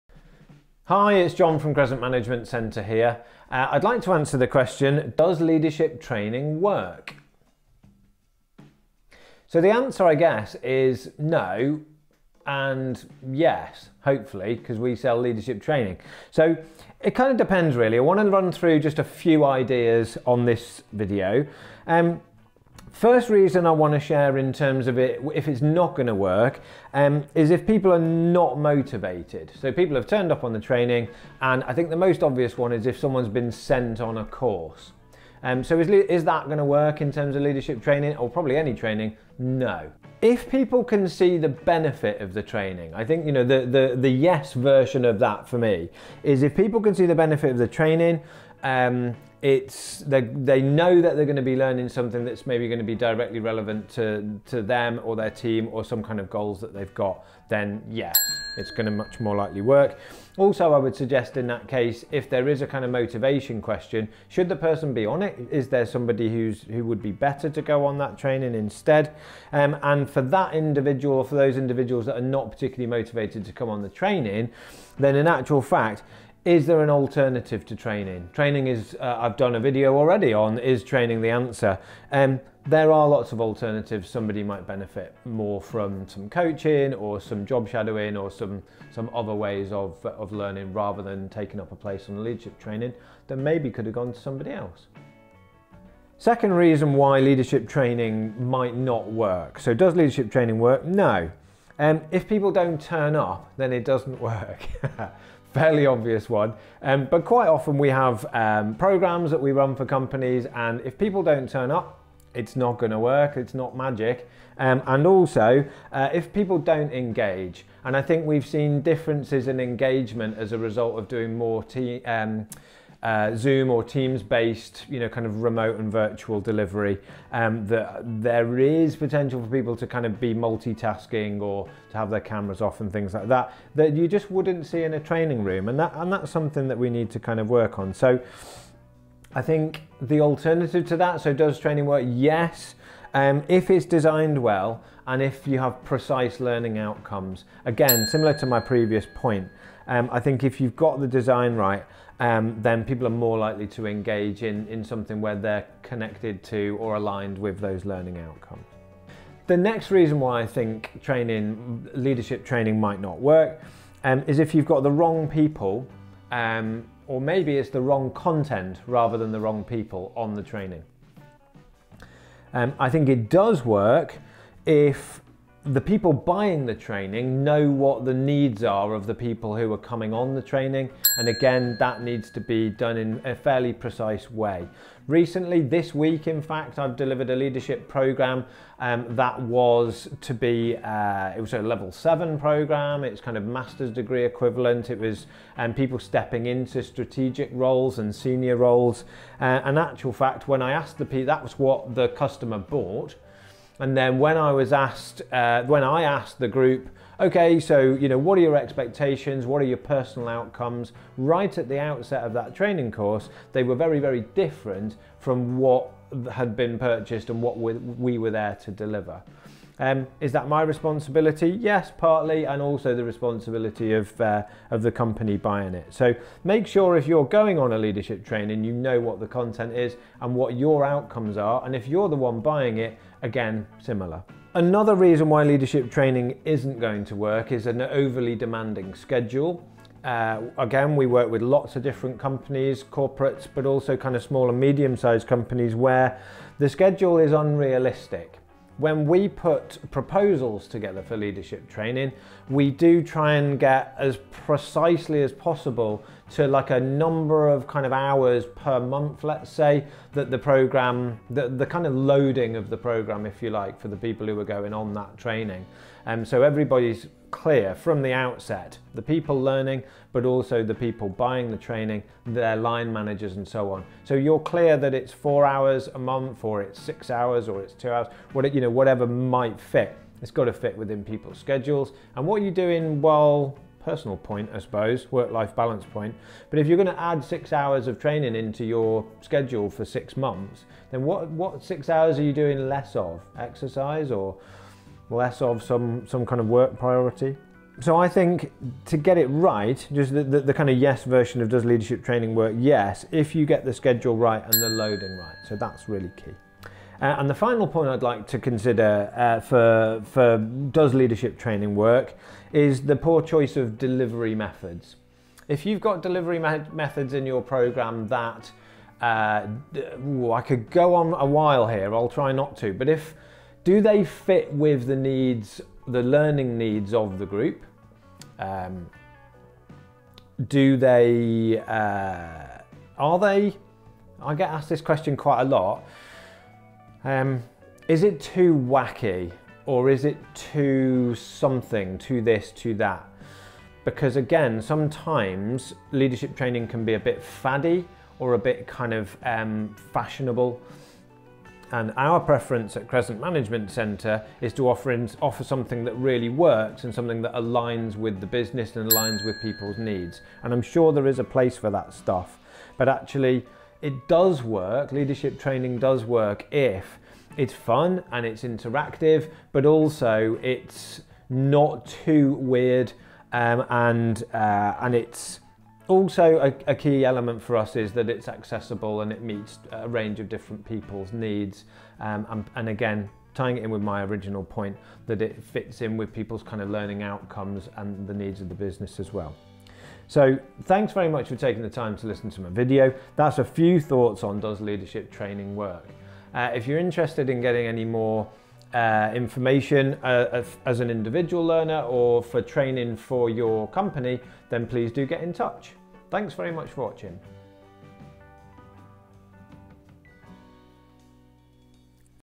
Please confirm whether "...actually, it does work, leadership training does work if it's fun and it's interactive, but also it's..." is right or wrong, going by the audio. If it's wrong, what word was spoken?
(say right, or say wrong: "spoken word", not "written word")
right.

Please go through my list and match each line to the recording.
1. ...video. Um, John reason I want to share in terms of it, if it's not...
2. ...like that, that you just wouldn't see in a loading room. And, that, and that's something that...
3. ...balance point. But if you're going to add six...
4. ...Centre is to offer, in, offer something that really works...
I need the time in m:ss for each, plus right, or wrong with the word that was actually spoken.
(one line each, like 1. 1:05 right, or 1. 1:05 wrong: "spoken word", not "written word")
1. 0:20 wrong: "First", not "John"
2. 2:13 wrong: "training", not "loading"
3. 4:45 right
4. 5:53 right.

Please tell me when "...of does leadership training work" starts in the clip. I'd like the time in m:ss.
5:01.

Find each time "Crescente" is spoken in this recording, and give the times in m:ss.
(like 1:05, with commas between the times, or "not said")
0:01, 5:52.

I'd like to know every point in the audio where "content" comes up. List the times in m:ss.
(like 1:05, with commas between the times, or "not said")
2:48, 3:49.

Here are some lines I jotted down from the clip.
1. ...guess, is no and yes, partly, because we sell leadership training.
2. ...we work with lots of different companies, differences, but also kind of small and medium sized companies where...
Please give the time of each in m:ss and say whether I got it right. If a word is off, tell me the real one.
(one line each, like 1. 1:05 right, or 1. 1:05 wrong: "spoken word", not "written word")
1. 0:10 wrong: "hopefully", not "partly"
2. 4:00 wrong: "corporates", not "differences".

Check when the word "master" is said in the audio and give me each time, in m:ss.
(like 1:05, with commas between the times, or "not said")
3:13.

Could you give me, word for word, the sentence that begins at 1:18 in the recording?
Training is, uh, I've done a video already on is training the answer.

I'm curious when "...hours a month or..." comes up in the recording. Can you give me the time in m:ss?
4:35.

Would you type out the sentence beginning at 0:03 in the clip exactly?
Uh, I'd like to answer the question, does leadership training work?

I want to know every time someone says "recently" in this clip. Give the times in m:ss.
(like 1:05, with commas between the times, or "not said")
3:05.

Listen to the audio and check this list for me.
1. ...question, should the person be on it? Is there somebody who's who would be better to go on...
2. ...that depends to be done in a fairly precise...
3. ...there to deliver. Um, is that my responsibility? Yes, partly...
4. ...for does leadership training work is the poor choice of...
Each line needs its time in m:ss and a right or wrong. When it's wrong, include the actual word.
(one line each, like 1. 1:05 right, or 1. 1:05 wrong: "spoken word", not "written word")
1. 1:03 right
2. 3:01 wrong: "needs", not "depends"
3. 3:38 right
4. 5:10 right.